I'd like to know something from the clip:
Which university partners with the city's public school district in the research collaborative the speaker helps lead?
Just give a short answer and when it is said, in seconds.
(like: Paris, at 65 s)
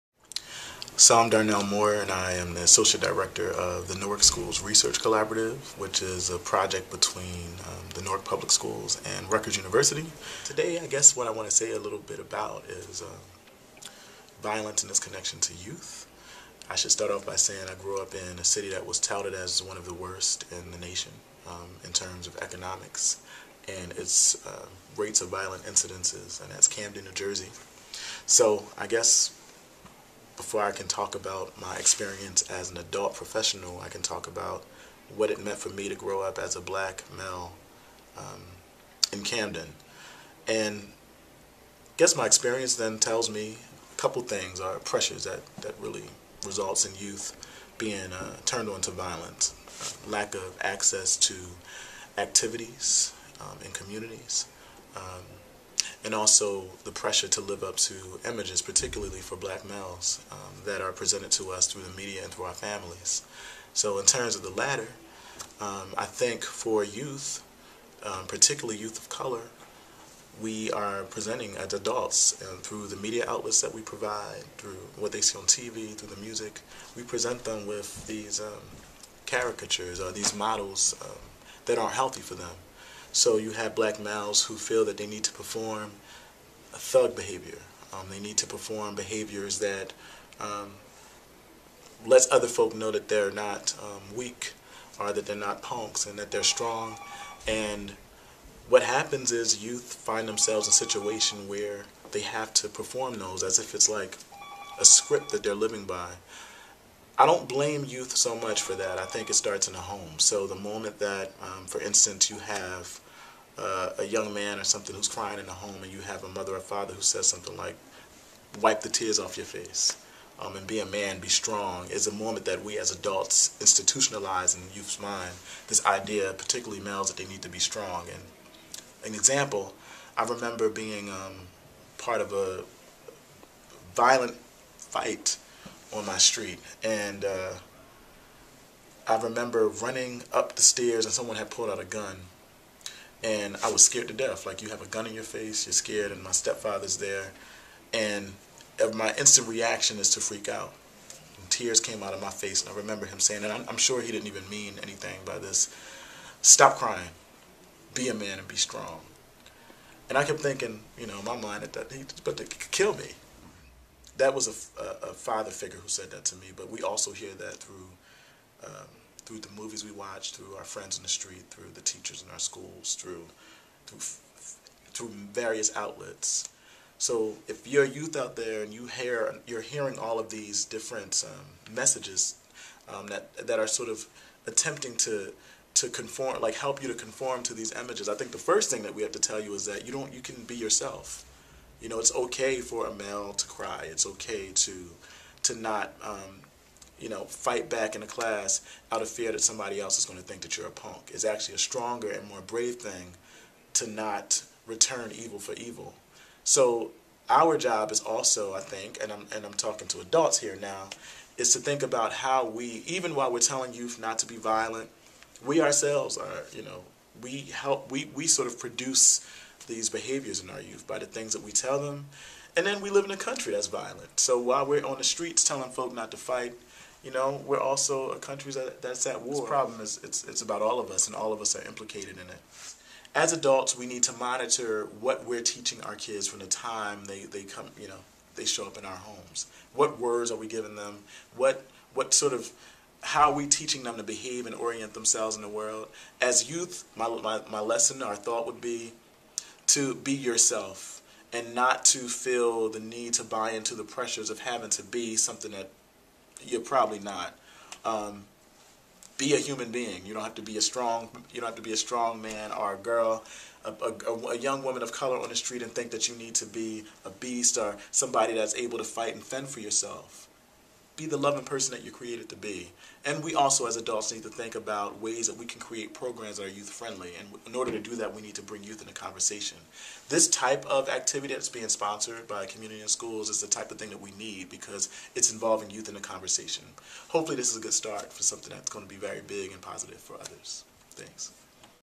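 Rutgers University, at 9 s.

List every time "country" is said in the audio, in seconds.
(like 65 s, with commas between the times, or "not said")
223 s, 228 s.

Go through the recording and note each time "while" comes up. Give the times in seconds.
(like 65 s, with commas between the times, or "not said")
213 s, 224 s.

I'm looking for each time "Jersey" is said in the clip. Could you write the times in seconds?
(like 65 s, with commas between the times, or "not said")
27 s.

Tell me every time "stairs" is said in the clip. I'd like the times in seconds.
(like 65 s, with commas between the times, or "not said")
140 s.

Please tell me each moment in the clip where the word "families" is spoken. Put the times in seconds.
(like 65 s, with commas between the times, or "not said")
62 s.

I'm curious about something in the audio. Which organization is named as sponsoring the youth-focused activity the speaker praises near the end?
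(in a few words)
Communities In Schools.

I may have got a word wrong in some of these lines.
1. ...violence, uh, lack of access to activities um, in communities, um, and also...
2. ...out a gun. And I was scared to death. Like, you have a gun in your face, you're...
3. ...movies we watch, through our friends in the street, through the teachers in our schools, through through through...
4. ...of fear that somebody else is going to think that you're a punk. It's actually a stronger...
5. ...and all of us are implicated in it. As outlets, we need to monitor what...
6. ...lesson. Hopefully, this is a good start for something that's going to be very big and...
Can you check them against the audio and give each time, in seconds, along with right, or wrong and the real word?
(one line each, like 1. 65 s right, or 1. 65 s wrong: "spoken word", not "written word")
1. 48 s right
2. 141 s right
3. 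169 s right
4. 199 s right
5. 231 s wrong: "adults", not "outlets"
6. 286 s wrong: "conversation", not "lesson".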